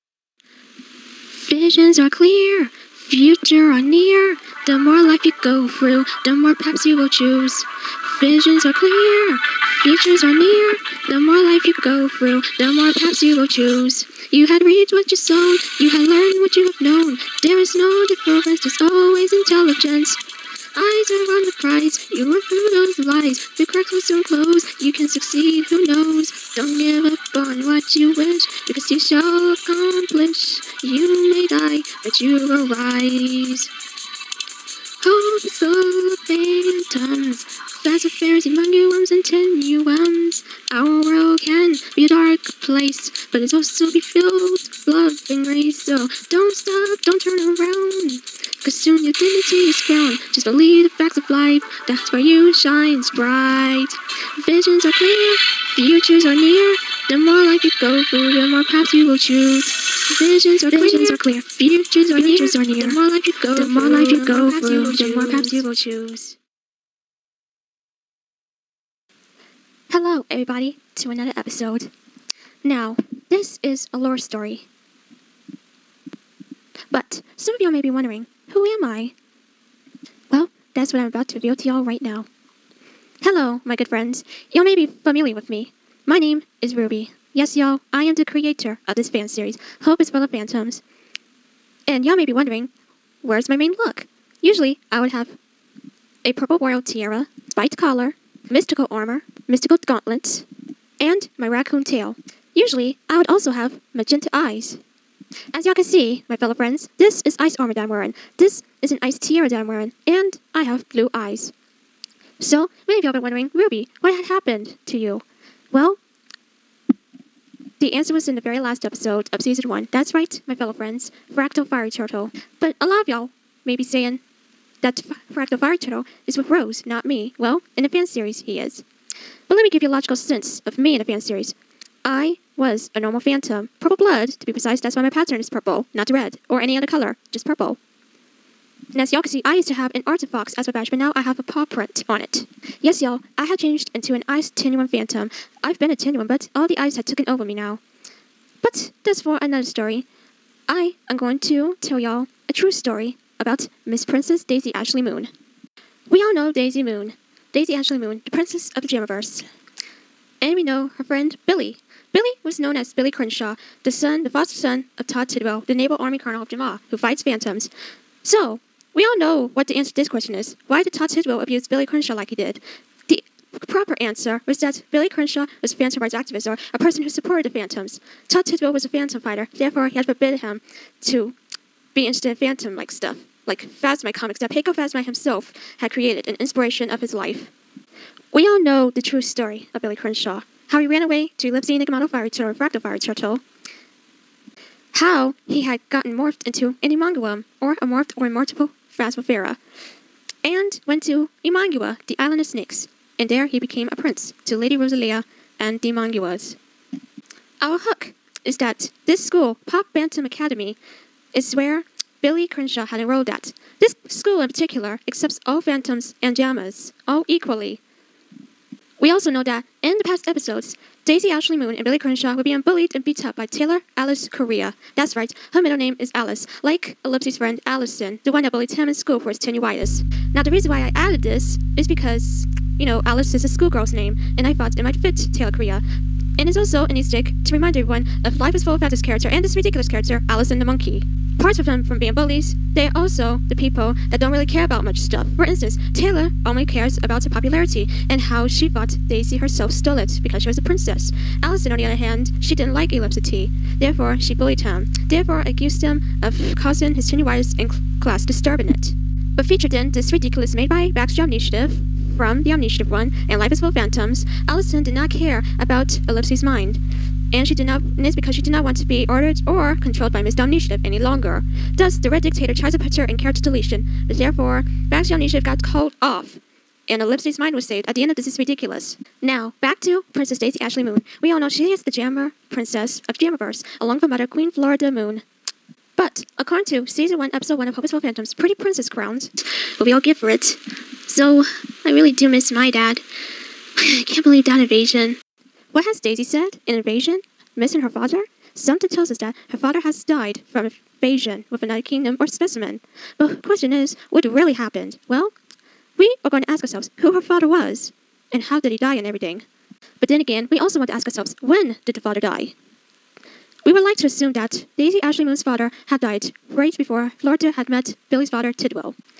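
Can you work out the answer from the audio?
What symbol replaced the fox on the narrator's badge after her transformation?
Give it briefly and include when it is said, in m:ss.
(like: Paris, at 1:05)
A paw print, at 2:21.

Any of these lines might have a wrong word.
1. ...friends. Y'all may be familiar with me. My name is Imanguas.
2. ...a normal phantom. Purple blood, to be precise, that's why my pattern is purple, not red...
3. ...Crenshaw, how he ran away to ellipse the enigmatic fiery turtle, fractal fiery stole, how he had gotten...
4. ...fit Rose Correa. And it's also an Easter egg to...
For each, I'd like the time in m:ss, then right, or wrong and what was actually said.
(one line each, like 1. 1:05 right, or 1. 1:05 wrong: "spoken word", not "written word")
1. 1:23 wrong: "Ruby", not "Imanguas"
2. 2:12 right
3. 3:09 wrong: "turtle", not "stole"
4. 3:54 wrong: "Taylor", not "Rose".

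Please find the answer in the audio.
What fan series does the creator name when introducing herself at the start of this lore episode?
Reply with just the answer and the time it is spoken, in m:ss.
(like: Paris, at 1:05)
Hope is Full of Phantoms, at 1:29.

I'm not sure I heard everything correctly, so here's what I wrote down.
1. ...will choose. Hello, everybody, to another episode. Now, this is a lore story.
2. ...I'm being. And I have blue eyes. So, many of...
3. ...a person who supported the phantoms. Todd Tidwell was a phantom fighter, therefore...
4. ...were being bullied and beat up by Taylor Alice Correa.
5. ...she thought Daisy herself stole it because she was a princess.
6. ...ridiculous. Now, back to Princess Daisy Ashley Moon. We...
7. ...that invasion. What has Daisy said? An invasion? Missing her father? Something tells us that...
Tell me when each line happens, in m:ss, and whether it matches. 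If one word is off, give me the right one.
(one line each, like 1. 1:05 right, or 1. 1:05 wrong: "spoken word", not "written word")
1. 1:05 right
2. 1:49 wrong: "wearing", not "being"
3. 2:56 right
4. 3:42 right
5. 4:08 right
6. 4:38 right
7. 4:54 right.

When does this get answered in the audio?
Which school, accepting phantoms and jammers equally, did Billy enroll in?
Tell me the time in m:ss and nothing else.
3:29.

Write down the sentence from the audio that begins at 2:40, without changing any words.
And we know her friend Billy.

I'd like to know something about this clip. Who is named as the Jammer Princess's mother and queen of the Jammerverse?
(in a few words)
Queen Florida Moon.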